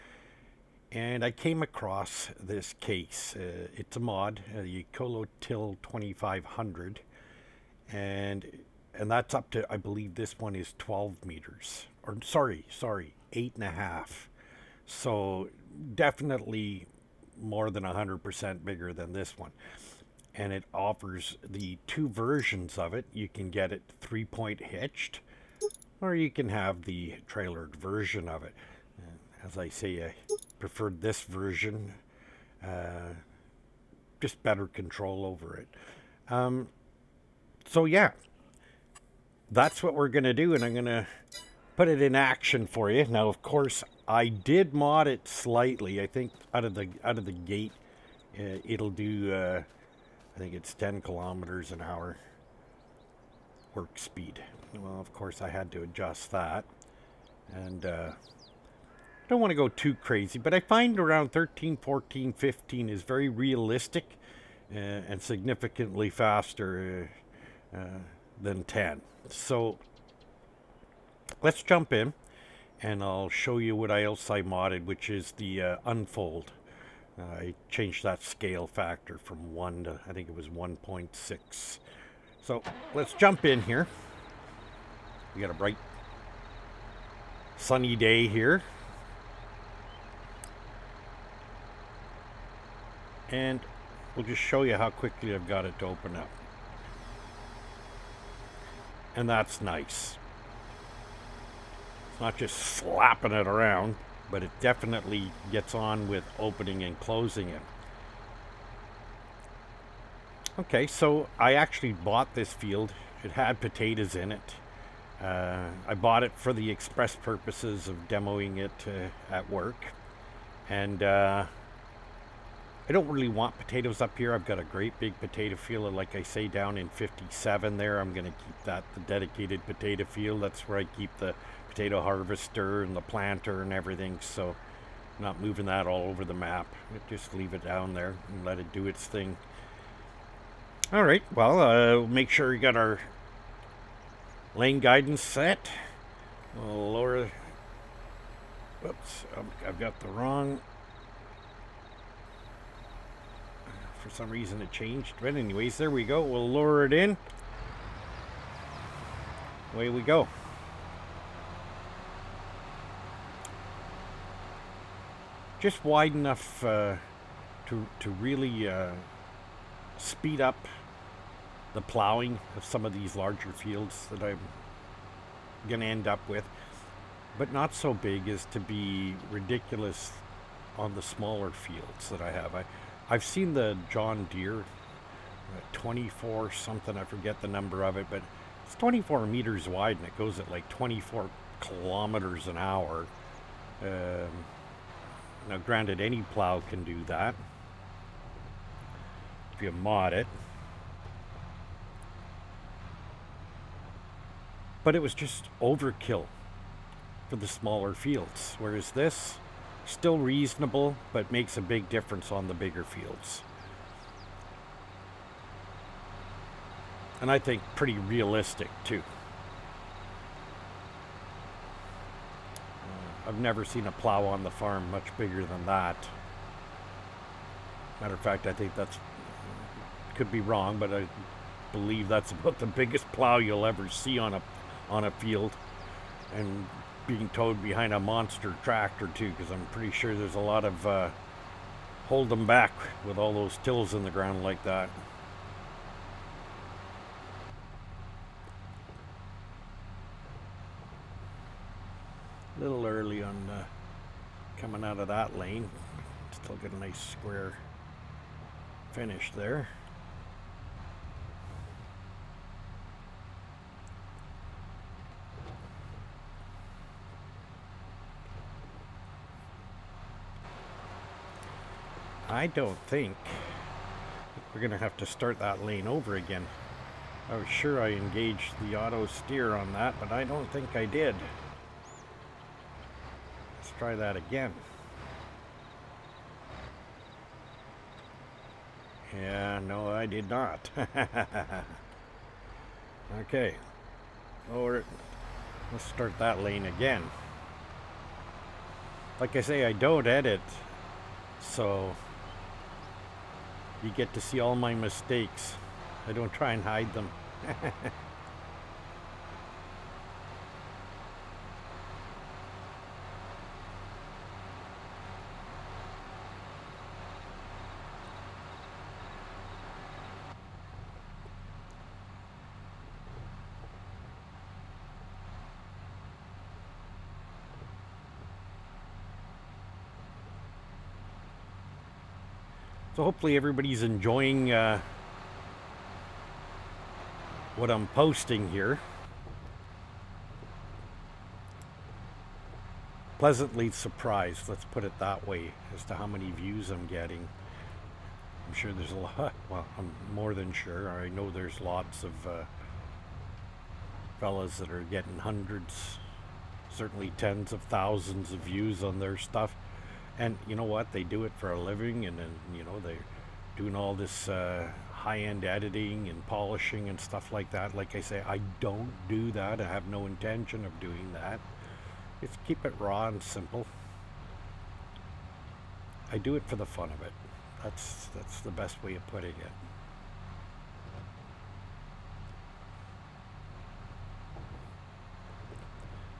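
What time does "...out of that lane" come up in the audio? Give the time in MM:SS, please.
04:14.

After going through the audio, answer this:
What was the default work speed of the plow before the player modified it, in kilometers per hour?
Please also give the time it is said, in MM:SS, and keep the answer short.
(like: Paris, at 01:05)
10, at 00:50.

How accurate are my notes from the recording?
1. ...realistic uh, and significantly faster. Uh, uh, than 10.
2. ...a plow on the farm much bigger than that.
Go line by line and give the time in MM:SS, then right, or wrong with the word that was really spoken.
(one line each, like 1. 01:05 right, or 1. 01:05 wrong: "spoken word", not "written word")
1. 01:03 right
2. 03:43 right.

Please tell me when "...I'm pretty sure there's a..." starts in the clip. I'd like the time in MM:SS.
03:59.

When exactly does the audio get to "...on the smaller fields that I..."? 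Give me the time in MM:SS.
03:00.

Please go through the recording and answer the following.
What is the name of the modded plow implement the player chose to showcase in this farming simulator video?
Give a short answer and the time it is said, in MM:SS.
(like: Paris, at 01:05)
Ecolo Til 2500, at 00:04.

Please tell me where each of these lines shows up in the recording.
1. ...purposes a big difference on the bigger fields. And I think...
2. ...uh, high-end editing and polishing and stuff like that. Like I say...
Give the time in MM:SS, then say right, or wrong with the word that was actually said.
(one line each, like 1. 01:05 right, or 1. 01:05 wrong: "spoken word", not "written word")
1. 03:31 wrong: "makes", not "purposes"
2. 06:04 right.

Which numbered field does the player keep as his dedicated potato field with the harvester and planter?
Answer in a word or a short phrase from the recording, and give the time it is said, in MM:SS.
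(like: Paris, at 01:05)
57, at 02:06.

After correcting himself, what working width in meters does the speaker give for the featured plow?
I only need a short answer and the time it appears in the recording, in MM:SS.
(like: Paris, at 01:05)
8.5 meters, at 00:13.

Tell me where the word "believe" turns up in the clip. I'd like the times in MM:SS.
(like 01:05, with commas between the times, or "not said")
00:09, 03:51.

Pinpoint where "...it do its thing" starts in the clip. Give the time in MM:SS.
02:18.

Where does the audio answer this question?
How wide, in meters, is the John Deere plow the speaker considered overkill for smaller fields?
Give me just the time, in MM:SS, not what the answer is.
03:08.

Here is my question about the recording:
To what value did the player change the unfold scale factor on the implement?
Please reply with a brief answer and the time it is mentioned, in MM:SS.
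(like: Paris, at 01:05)
1.6, at 01:20.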